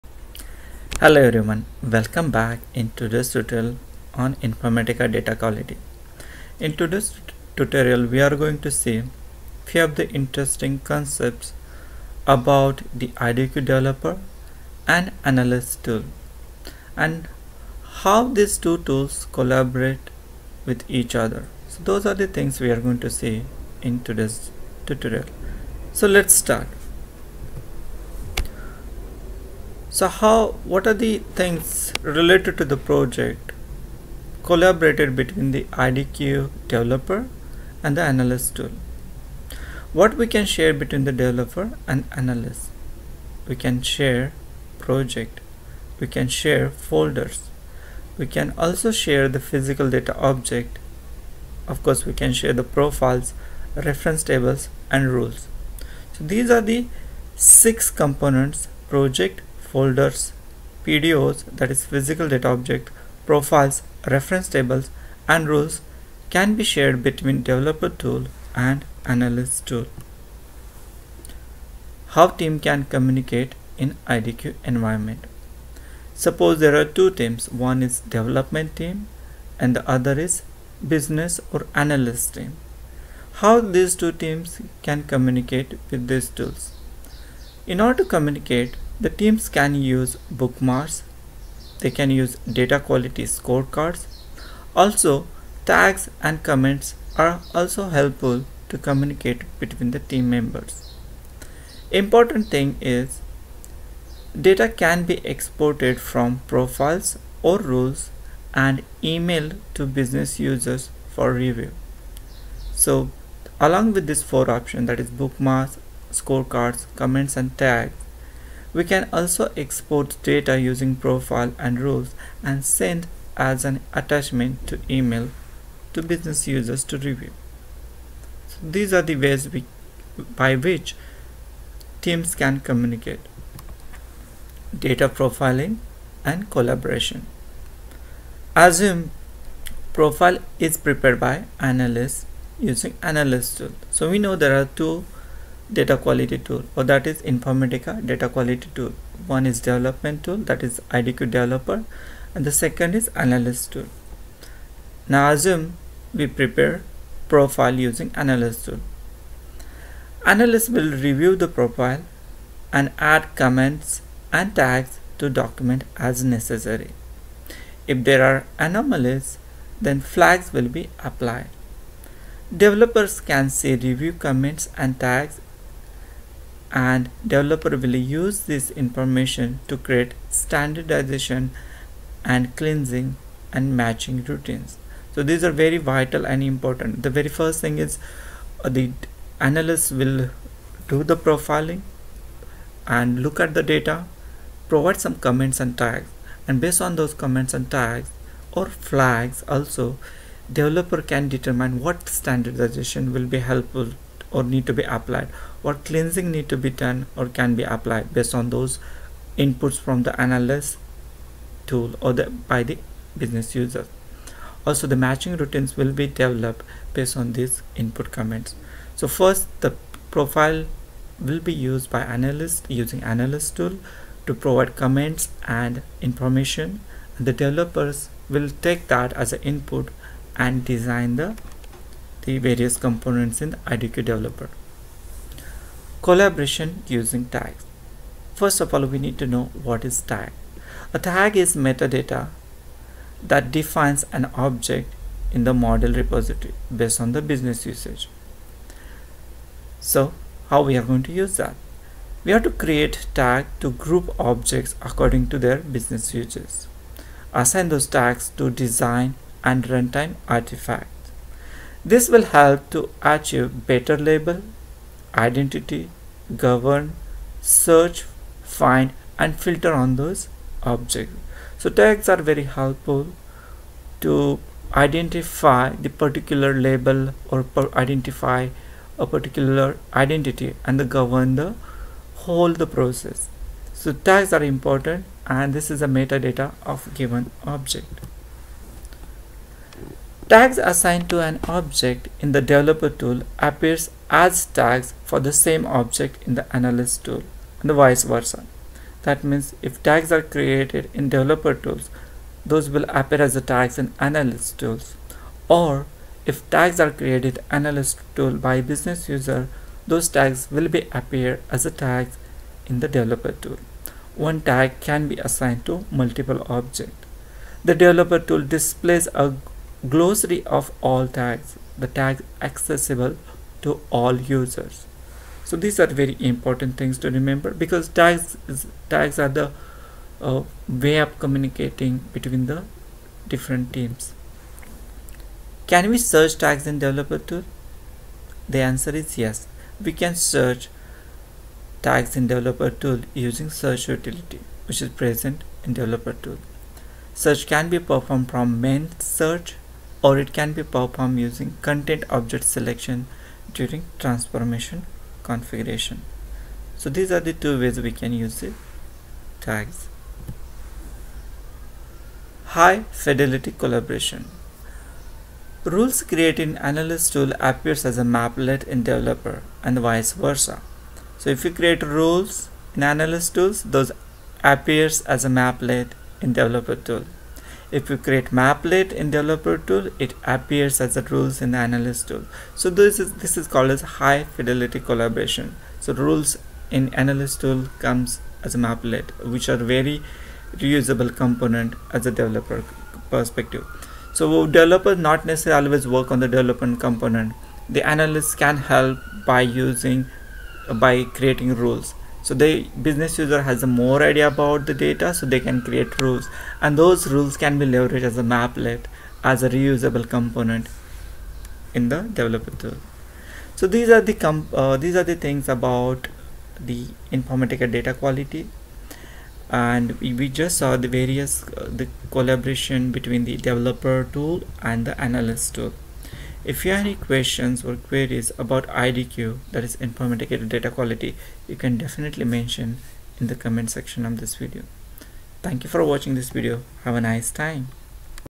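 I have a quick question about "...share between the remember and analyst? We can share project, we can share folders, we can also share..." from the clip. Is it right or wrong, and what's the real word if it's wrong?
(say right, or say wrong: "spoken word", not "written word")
wrong: "developer", not "remember".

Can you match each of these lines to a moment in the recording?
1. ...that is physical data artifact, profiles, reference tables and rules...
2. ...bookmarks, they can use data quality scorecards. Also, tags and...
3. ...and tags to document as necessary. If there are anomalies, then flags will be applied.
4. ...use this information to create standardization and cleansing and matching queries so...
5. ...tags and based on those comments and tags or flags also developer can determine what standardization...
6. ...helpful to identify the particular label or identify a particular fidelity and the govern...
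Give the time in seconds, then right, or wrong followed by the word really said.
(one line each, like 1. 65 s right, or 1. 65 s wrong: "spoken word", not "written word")
1. 61 s wrong: "object", not "artifact"
2. 90 s right
3. 164 s right
4. 177 s wrong: "routines", not "queries"
5. 195 s right
6. 272 s wrong: "identity", not "fidelity".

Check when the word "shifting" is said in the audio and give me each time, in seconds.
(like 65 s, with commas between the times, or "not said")
not said.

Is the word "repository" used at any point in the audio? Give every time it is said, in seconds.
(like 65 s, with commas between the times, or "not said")
245 s.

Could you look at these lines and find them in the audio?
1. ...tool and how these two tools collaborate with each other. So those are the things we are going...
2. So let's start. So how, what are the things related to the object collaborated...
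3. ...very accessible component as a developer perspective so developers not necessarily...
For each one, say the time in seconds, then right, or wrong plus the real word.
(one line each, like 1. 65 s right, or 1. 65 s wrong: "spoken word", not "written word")
1. 15 s right
2. 25 s wrong: "project", not "object"
3. 389 s wrong: "reusable", not "accessible".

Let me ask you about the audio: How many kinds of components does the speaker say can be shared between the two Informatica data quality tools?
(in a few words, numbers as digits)
6.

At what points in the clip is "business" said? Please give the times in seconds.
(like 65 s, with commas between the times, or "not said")
80 s, 109 s, 126 s, 213 s, 247 s, 255 s, 308 s, 402 s.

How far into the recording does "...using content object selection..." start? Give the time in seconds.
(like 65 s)
351 s.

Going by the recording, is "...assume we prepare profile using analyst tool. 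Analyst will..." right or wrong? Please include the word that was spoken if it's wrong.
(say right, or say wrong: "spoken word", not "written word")
right.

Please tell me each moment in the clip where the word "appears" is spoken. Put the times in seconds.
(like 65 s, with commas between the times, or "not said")
293 s, 303 s, 310 s, 367 s, 374 s, 380 s.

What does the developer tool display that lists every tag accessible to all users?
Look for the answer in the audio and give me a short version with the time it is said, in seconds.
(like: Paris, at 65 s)
A glossary, at 319 s.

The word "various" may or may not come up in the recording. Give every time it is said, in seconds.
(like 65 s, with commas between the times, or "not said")
232 s, 420 s.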